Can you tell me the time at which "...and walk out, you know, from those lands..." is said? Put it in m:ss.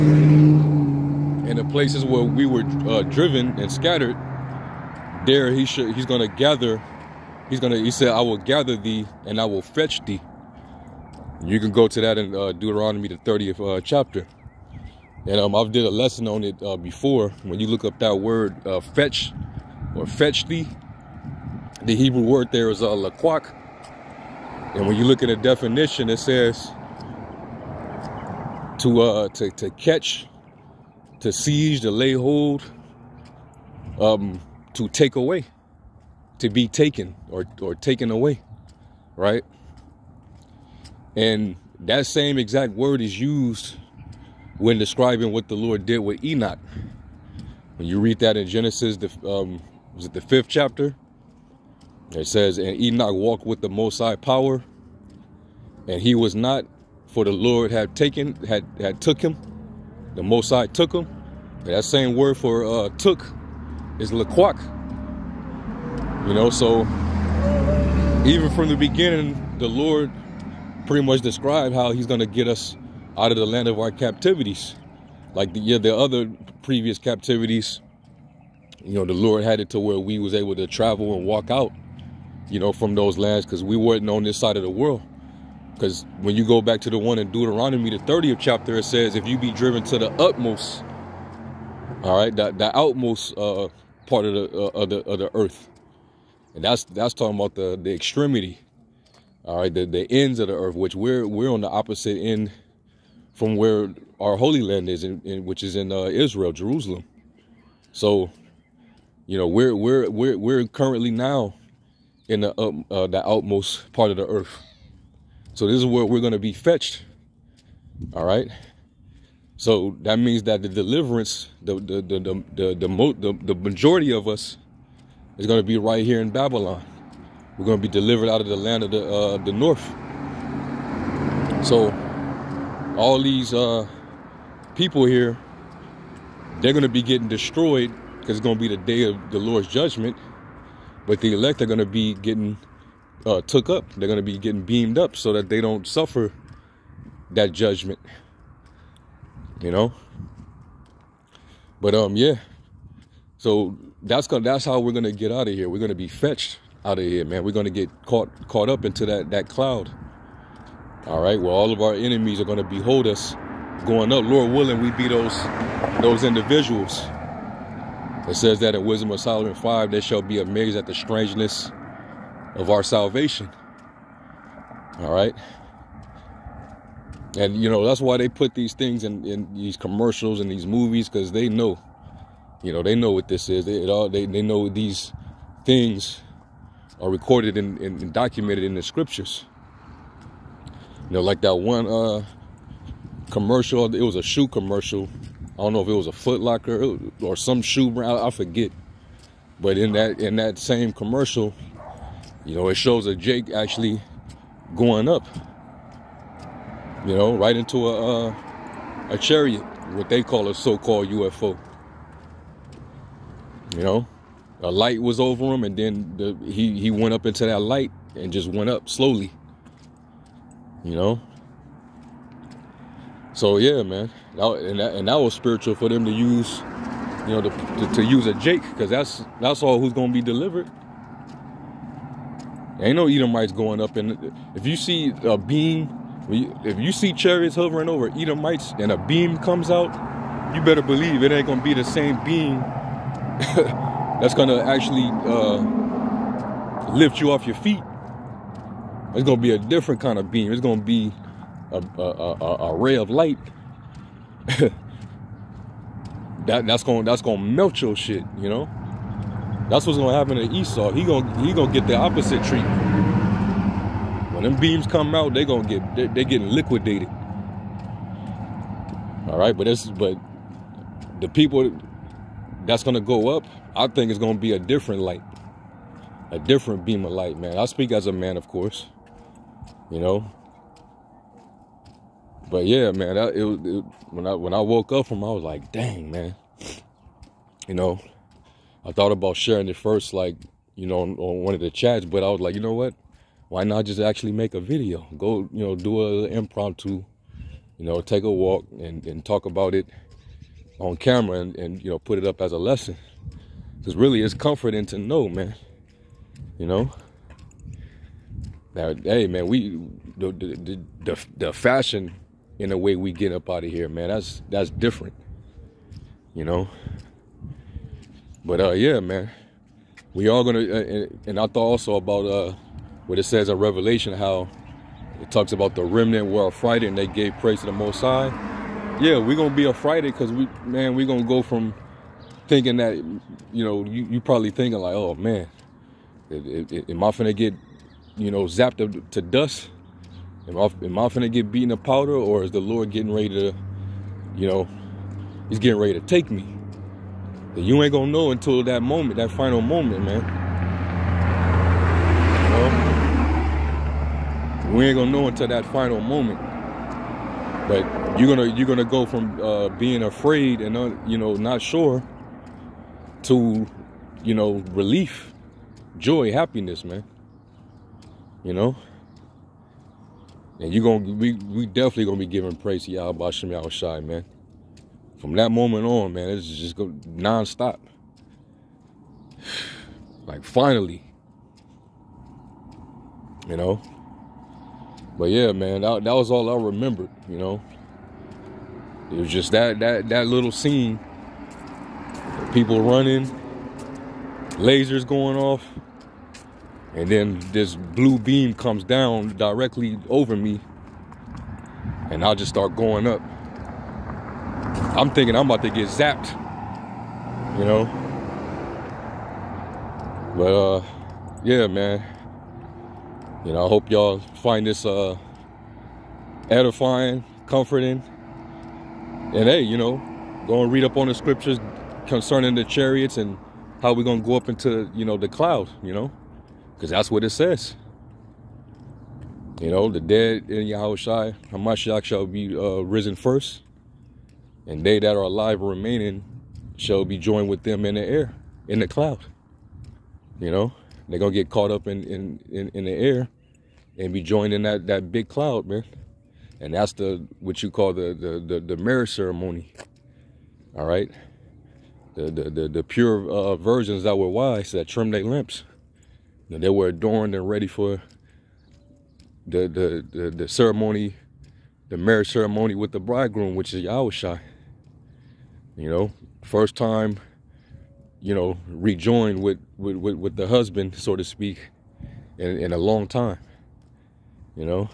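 1:21.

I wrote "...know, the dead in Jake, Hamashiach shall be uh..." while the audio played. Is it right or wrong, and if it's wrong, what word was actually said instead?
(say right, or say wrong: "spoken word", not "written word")
wrong: "Yahushua", not "Jake".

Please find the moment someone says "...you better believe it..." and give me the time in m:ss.
4:00.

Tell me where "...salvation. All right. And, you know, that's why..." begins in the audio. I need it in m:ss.
2:52.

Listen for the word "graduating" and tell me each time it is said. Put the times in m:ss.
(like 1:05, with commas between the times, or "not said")
not said.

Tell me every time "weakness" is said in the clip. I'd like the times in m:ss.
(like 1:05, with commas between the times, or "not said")
not said.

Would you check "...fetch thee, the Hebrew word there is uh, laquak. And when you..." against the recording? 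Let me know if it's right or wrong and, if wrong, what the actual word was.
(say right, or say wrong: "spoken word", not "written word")
right.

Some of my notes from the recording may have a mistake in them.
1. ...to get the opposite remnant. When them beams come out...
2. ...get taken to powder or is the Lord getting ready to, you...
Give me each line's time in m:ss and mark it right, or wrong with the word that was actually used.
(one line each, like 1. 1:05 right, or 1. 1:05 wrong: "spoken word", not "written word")
1. 4:21 wrong: "treatment", not "remnant"
2. 5:41 wrong: "beaten", not "taken".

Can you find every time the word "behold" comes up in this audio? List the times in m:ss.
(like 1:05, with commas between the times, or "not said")
2:42.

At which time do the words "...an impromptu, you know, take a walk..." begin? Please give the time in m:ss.
4:56.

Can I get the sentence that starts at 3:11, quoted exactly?
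You know, like that one uh, commercial, it was a shoe commercial.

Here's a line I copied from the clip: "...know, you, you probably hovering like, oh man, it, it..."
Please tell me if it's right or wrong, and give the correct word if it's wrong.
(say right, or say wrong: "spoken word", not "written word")
wrong: "thinking", not "hovering".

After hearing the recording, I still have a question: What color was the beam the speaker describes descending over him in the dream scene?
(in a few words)
Blue.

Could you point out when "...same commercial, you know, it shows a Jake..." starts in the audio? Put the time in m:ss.
3:20.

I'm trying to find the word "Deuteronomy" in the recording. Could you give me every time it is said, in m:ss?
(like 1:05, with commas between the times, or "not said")
0:12, 1:27.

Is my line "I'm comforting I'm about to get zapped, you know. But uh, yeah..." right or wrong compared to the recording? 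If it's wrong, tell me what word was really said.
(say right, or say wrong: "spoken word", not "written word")
wrong: "thinking", not "comforting".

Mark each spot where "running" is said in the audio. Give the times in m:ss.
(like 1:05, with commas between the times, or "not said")
6:32.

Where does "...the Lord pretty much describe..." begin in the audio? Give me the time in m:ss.
1:09.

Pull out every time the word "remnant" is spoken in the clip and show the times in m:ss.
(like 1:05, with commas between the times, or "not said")
5:25.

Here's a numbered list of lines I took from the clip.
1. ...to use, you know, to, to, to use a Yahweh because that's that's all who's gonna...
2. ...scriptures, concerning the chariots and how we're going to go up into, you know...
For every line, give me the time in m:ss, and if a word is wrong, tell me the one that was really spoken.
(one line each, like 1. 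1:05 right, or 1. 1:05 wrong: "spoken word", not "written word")
1. 3:46 wrong: "Jake", not "Yahweh"
2. 7:01 right.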